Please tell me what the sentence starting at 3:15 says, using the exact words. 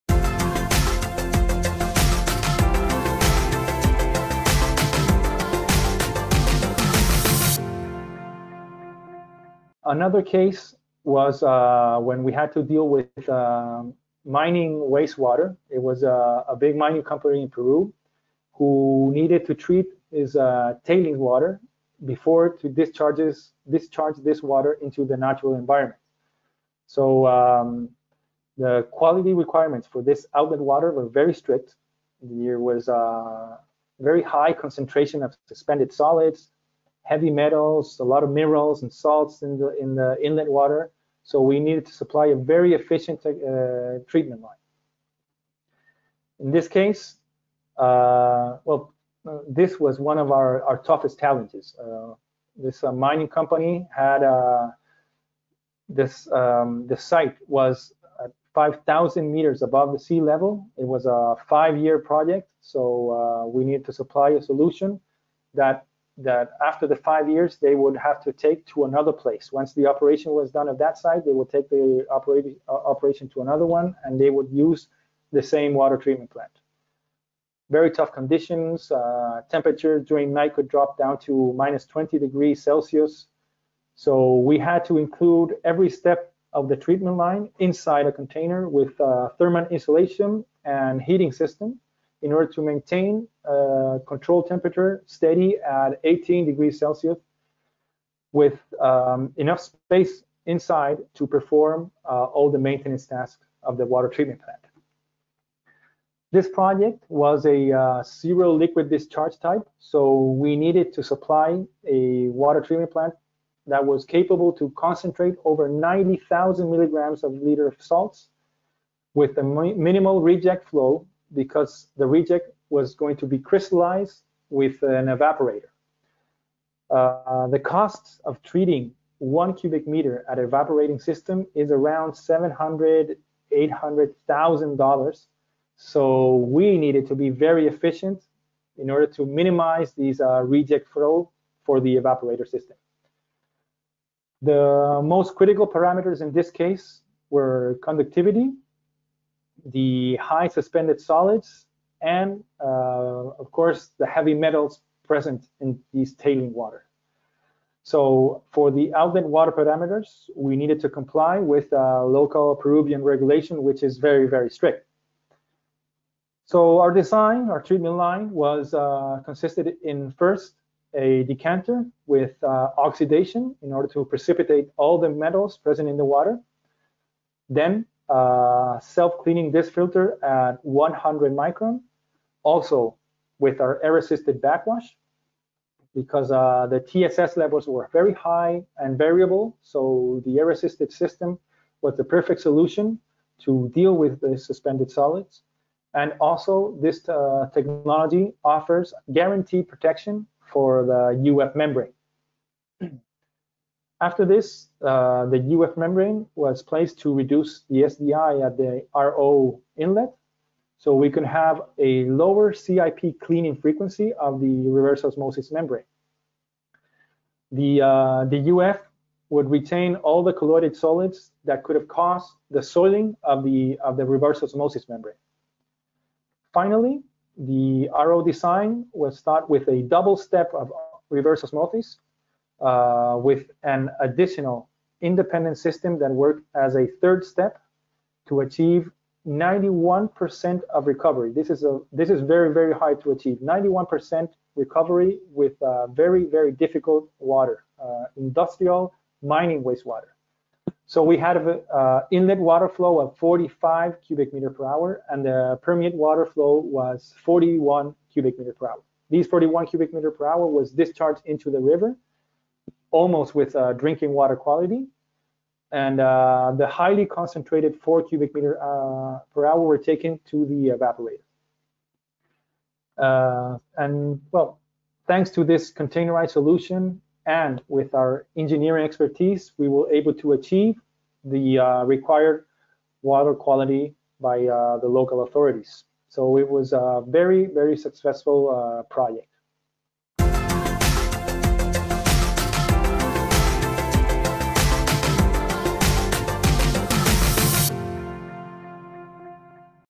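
And also, this uh, technology offers guaranteed protection for the UF membrane.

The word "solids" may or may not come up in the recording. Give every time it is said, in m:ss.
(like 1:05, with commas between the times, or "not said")
0:35, 2:30, 3:14, 3:40.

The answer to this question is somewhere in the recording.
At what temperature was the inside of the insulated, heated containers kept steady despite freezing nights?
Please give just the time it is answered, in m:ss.
1:36.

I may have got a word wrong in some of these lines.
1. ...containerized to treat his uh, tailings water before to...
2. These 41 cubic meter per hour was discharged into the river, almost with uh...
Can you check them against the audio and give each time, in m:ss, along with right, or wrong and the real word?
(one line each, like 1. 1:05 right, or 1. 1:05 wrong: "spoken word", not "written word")
1. 0:19 wrong: "needed", not "containerized"
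2. 4:19 right.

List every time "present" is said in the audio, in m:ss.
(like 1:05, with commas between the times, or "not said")
2:35, 2:55.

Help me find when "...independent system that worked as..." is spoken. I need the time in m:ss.
3:55.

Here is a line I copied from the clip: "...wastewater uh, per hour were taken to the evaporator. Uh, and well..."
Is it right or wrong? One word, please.
wrong.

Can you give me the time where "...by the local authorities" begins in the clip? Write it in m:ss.
4:44.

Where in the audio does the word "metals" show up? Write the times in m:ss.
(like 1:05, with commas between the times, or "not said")
0:37, 2:34, 2:55.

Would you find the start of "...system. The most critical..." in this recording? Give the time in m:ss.
2:22.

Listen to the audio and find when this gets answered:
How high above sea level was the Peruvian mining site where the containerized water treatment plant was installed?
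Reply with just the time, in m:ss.
0:58.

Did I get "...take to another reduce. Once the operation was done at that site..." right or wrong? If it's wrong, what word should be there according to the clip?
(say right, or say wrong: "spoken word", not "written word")
wrong: "place", not "reduce".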